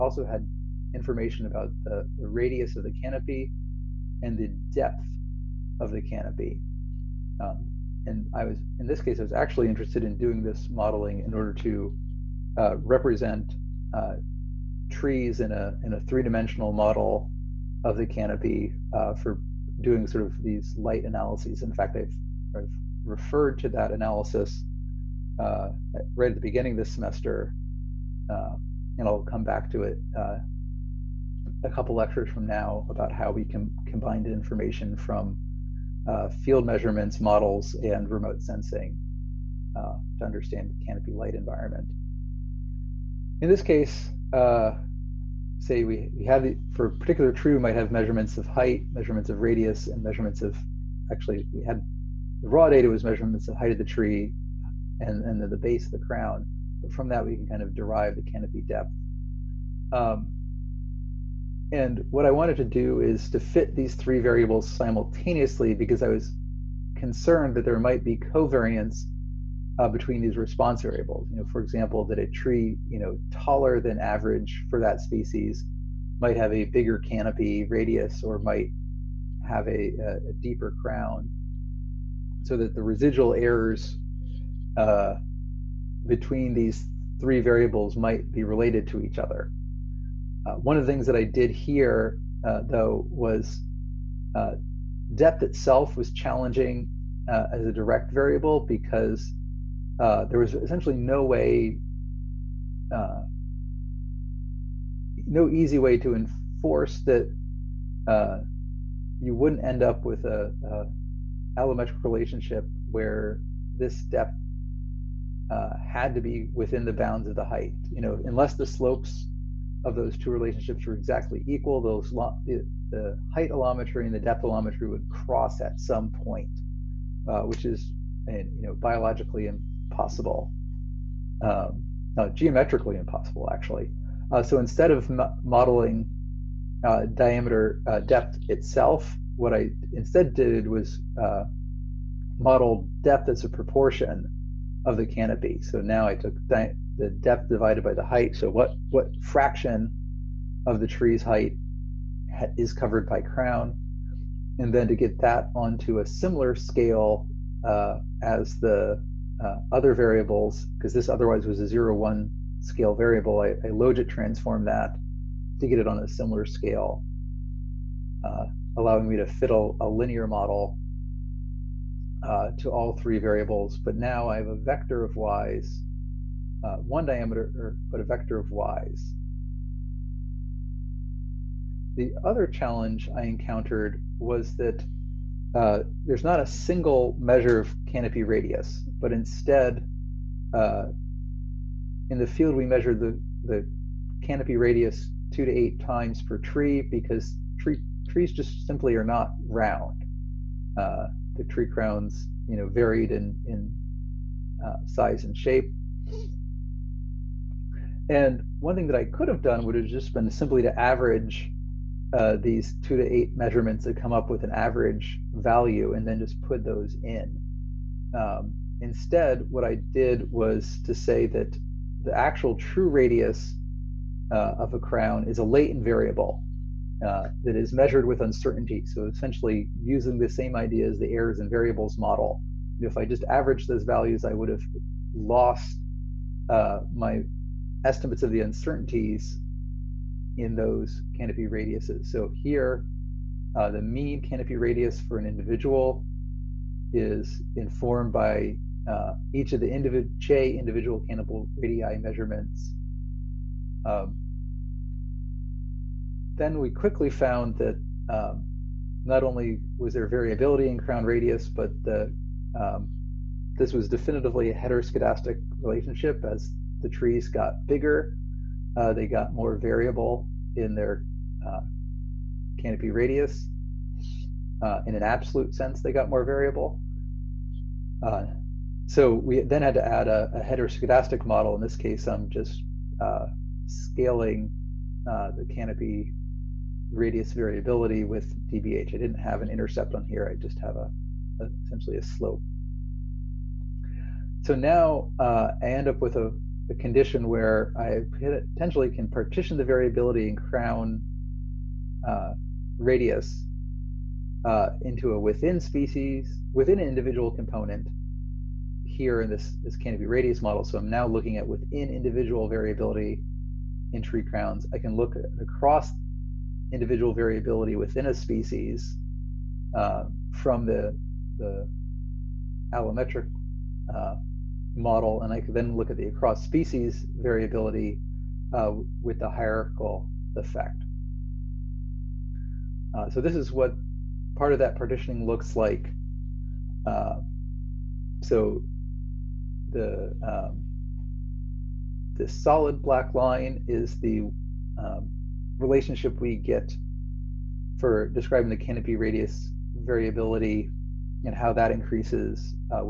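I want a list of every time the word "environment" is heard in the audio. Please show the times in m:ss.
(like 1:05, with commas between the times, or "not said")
0:41.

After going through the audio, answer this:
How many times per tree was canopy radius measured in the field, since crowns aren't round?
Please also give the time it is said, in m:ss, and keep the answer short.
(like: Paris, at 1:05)
2 to 8 times, at 3:15.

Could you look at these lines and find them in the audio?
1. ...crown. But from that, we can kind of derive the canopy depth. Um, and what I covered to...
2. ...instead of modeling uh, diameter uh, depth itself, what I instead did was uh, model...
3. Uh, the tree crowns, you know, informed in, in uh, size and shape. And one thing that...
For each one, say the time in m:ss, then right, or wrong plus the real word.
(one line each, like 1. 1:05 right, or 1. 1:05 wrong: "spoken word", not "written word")
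1. 0:55 wrong: "wanted", not "covered"
2. 2:14 right
3. 3:20 wrong: "varied", not "informed".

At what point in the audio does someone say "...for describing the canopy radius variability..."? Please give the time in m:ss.
5:47.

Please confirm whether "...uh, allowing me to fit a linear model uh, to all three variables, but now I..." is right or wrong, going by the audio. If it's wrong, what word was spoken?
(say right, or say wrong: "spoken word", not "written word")
right.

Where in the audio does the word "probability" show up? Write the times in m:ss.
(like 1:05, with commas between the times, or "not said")
not said.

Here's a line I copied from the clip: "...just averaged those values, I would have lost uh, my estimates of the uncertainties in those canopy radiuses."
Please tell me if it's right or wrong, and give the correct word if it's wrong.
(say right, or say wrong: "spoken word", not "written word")
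right.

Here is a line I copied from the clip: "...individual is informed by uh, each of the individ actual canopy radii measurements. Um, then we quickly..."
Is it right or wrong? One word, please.
wrong.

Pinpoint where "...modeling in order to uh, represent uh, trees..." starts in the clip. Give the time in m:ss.
0:10.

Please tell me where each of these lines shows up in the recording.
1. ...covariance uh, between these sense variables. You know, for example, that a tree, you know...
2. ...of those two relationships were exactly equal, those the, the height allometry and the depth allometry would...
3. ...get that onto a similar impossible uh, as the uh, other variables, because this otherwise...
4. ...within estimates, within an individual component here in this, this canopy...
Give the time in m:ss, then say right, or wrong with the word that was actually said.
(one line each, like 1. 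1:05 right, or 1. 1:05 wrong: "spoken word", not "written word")
1. 1:08 wrong: "response", not "sense"
2. 1:59 right
3. 2:34 wrong: "scale", not "impossible"
4. 5:05 wrong: "species", not "estimates".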